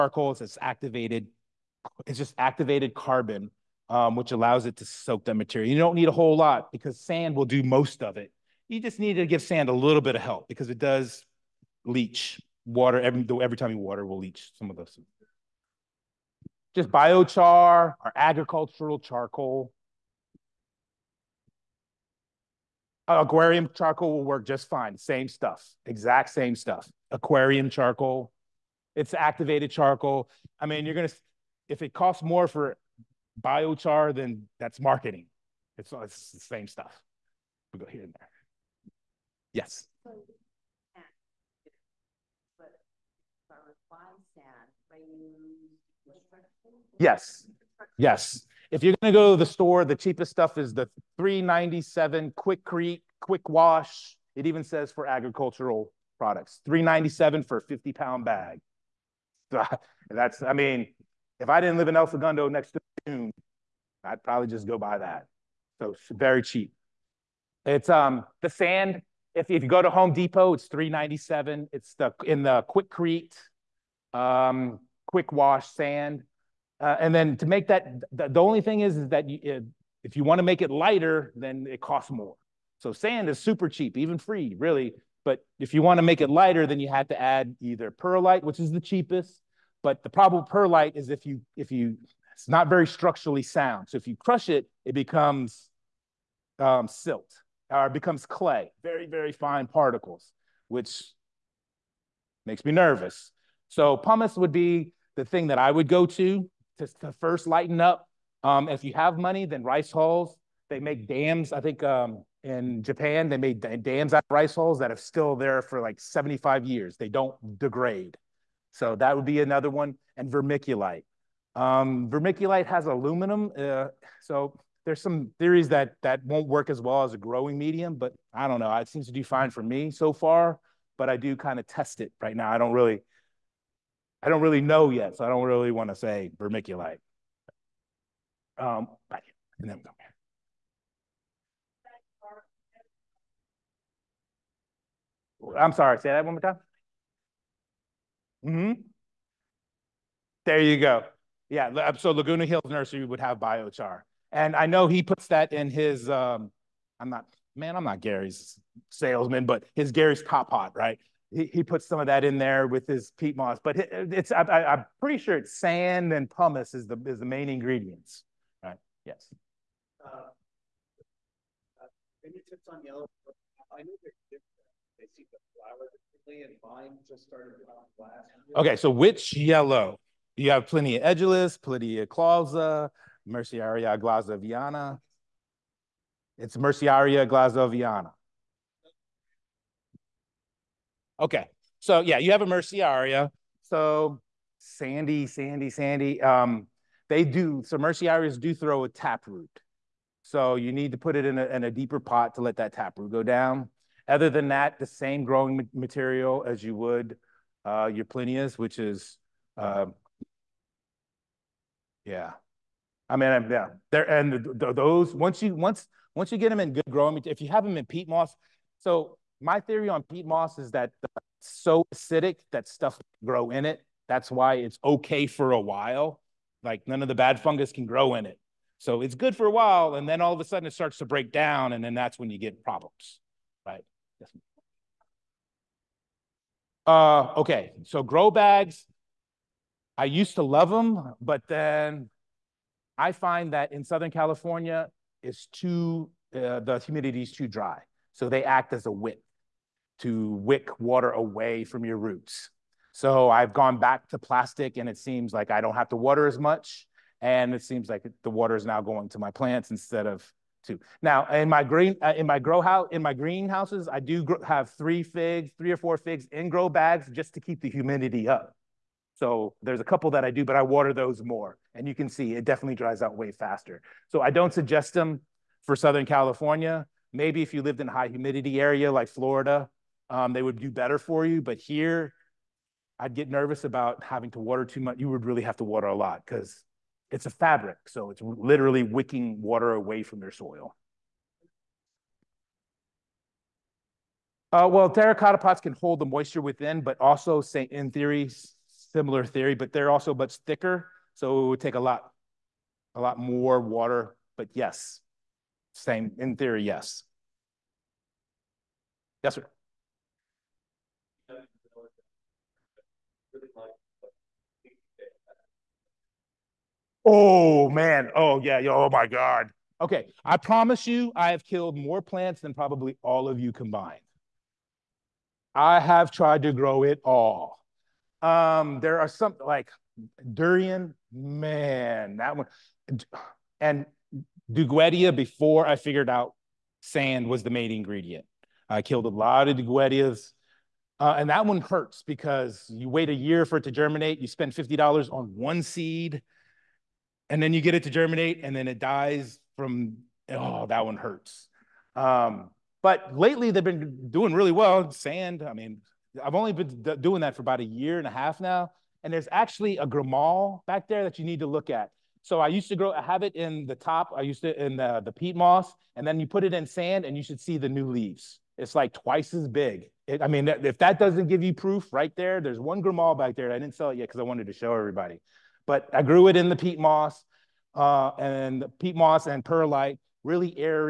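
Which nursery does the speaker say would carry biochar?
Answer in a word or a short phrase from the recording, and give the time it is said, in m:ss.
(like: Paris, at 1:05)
Laguna Hills Nursery, at 2:32.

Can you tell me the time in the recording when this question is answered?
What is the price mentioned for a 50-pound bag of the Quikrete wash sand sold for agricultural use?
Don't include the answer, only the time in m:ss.
0:56.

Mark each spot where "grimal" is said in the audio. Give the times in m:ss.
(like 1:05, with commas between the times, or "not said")
5:59, 6:12.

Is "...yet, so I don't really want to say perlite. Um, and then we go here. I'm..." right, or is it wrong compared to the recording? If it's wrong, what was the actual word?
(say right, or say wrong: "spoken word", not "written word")
wrong: "vermiculite", not "perlite".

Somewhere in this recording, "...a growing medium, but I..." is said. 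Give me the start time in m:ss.
2:07.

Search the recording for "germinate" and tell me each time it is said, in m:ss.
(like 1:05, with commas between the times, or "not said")
5:43, 5:47.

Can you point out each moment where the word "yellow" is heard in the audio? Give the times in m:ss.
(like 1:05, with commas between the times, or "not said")
2:52, 2:59.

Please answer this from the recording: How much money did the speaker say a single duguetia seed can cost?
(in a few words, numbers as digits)
$50.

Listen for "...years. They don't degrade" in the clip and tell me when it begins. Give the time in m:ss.
1:56.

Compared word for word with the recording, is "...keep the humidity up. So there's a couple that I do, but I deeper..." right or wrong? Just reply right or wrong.
wrong.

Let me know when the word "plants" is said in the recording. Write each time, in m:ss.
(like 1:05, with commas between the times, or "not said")
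4:19, 5:21.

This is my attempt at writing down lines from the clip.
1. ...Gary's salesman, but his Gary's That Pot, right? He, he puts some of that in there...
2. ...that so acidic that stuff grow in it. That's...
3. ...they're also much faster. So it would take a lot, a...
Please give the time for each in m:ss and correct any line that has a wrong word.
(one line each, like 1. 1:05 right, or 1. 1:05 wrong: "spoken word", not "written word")
1. 2:37 wrong: "Top", not "That"
2. 3:40 right
3. 4:59 wrong: "thicker", not "faster".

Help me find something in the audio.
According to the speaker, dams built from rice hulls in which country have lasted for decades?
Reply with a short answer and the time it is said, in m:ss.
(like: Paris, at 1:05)
Japan, at 1:52.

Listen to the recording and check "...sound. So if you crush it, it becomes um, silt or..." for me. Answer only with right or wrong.
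right.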